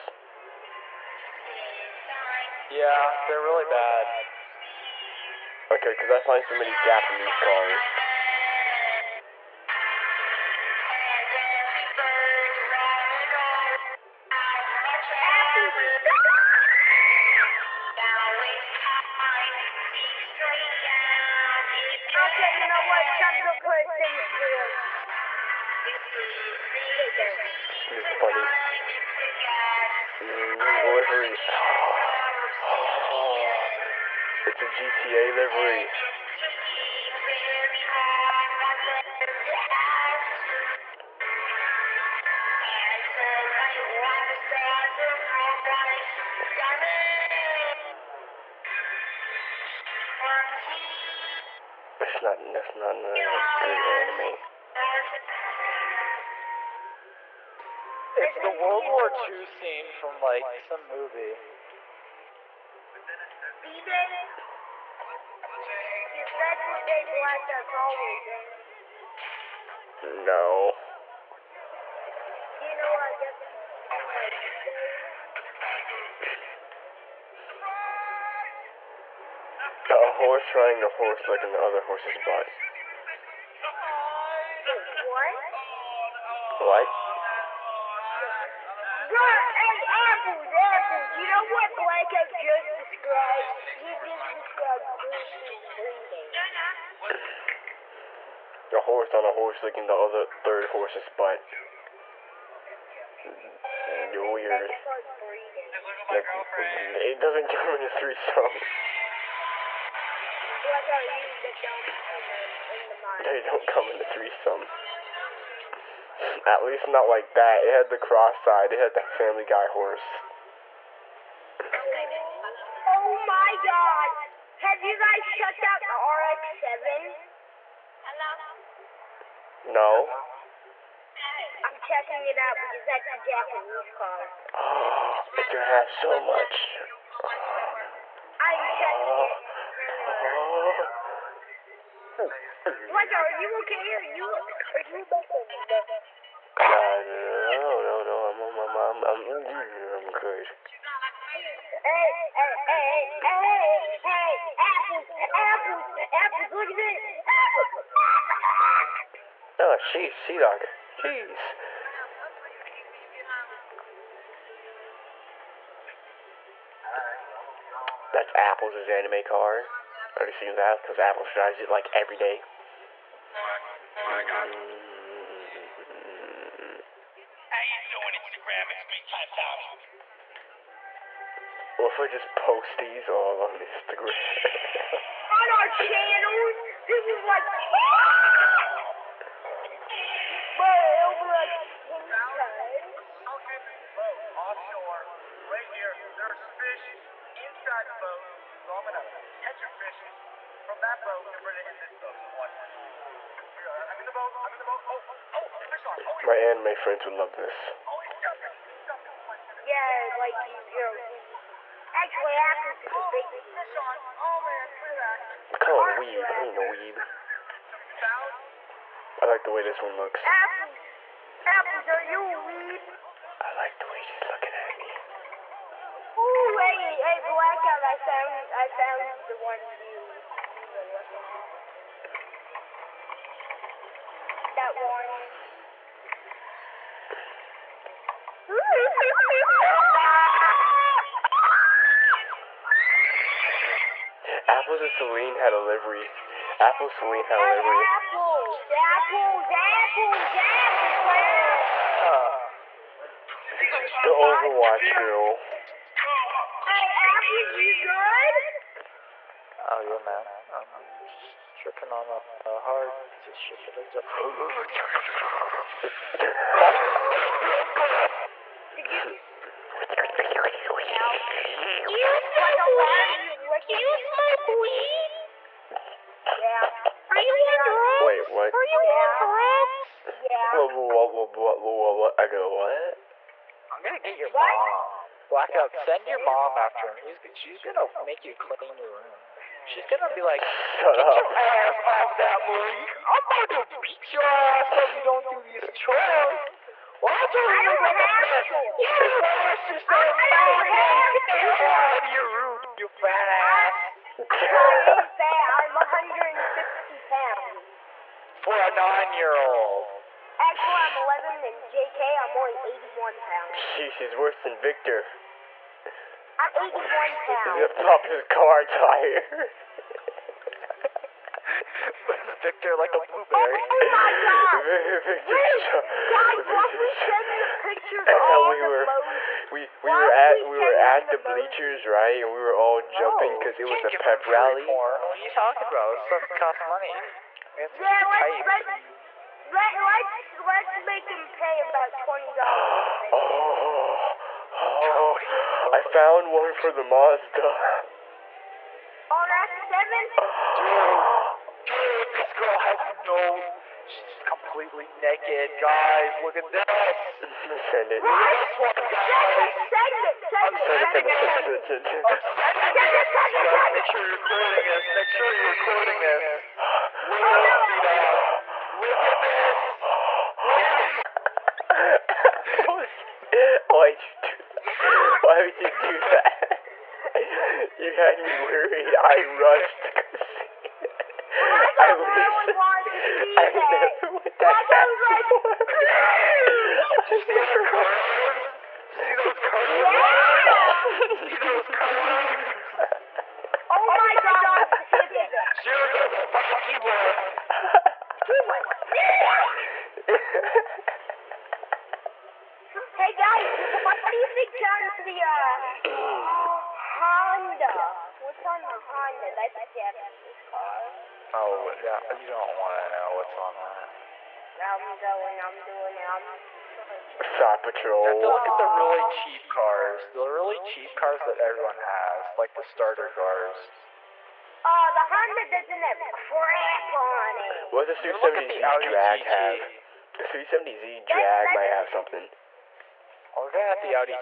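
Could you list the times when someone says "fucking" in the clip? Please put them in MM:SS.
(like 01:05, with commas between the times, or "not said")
05:00, 06:37.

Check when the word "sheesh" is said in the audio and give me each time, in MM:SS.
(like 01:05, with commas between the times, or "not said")
02:39, 05:13.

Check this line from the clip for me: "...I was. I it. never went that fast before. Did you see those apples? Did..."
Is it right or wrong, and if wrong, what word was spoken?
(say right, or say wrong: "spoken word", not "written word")
wrong: "curves", not "apples".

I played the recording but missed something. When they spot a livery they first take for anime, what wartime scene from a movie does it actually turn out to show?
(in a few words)
World War II.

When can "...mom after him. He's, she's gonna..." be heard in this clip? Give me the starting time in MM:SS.
04:46.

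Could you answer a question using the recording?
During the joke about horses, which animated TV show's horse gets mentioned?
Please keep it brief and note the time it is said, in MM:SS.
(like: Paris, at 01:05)
Family Guy, at 01:59.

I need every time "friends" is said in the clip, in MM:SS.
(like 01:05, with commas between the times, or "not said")
03:26.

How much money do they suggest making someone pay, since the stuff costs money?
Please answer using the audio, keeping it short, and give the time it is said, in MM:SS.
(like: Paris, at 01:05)
$20, at 05:42.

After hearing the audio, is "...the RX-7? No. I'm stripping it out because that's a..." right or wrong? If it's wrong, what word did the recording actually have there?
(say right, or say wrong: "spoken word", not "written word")
wrong: "checking", not "stripping".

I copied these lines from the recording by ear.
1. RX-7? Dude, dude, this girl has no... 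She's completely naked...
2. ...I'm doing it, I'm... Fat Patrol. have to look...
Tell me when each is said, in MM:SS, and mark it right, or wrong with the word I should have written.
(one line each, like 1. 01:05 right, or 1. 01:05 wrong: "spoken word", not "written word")
1. 05:49 right
2. 06:55 right.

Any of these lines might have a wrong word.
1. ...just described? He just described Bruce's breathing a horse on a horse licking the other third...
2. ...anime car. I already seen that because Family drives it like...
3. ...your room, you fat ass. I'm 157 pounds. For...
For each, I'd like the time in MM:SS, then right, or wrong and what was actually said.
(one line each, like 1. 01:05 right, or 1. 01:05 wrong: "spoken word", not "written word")
1. 01:32 right
2. 02:48 wrong: "Apples", not "Family"
3. 05:02 wrong: "150", not "157".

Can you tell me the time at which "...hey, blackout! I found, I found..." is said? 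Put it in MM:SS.
03:46.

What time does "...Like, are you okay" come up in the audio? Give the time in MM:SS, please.
02:22.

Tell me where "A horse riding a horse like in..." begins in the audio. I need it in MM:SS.
01:19.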